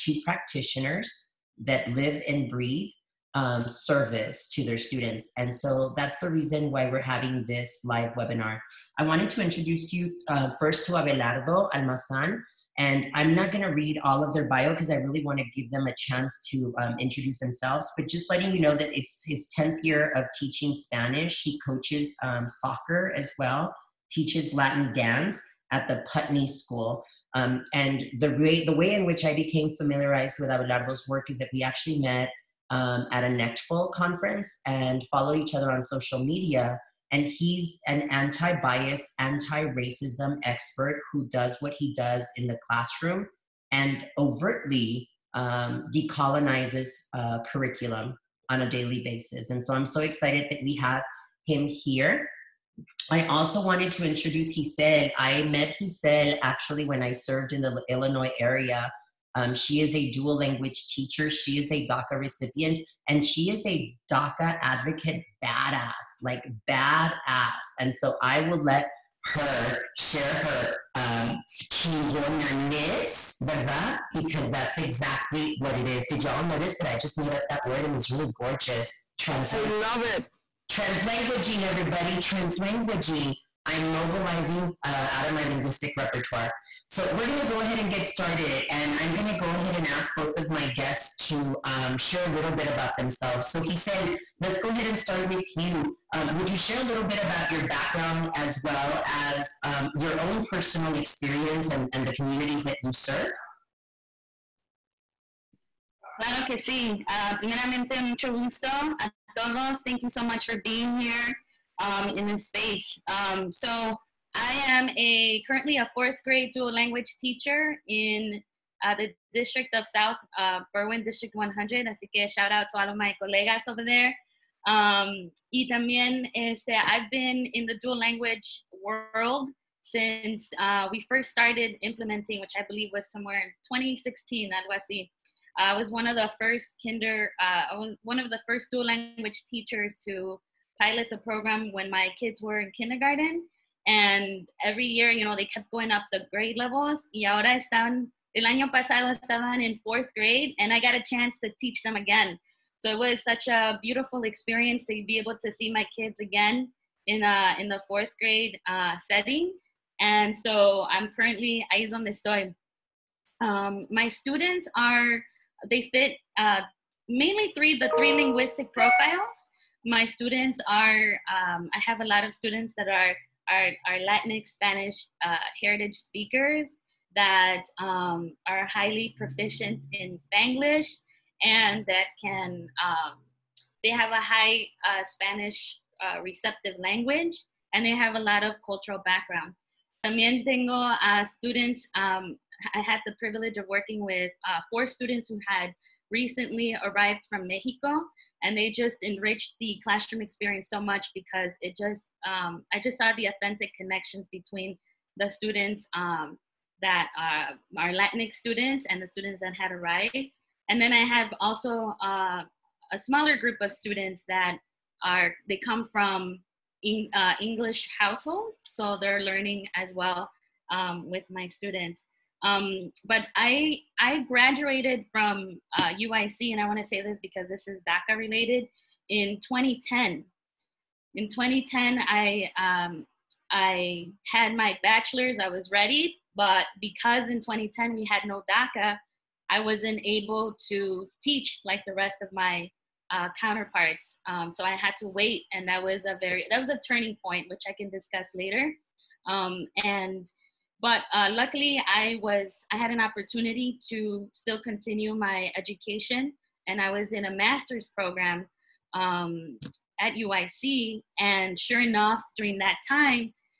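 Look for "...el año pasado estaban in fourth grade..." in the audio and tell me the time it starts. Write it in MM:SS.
02:28.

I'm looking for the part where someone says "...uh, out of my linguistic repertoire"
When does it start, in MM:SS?
01:24.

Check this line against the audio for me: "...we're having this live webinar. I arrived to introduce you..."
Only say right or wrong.
wrong.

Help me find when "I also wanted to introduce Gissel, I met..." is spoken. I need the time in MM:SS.
00:53.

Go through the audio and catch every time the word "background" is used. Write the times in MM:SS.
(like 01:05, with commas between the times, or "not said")
01:37, 03:09.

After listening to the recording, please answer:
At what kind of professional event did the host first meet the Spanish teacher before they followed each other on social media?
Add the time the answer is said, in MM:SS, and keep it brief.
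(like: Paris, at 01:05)
NECTFL conference, at 00:33.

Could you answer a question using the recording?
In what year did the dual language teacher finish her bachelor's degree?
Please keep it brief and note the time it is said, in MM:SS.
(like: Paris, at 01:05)
2010, at 03:49.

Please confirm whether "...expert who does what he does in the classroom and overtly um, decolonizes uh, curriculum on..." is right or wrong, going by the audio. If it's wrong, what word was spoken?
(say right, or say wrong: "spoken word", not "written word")
right.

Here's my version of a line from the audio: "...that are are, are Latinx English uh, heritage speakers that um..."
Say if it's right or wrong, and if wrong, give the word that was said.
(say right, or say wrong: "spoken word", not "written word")
wrong: "Spanish", not "English".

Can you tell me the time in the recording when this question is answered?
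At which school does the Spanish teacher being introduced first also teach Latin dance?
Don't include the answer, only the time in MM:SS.
00:25.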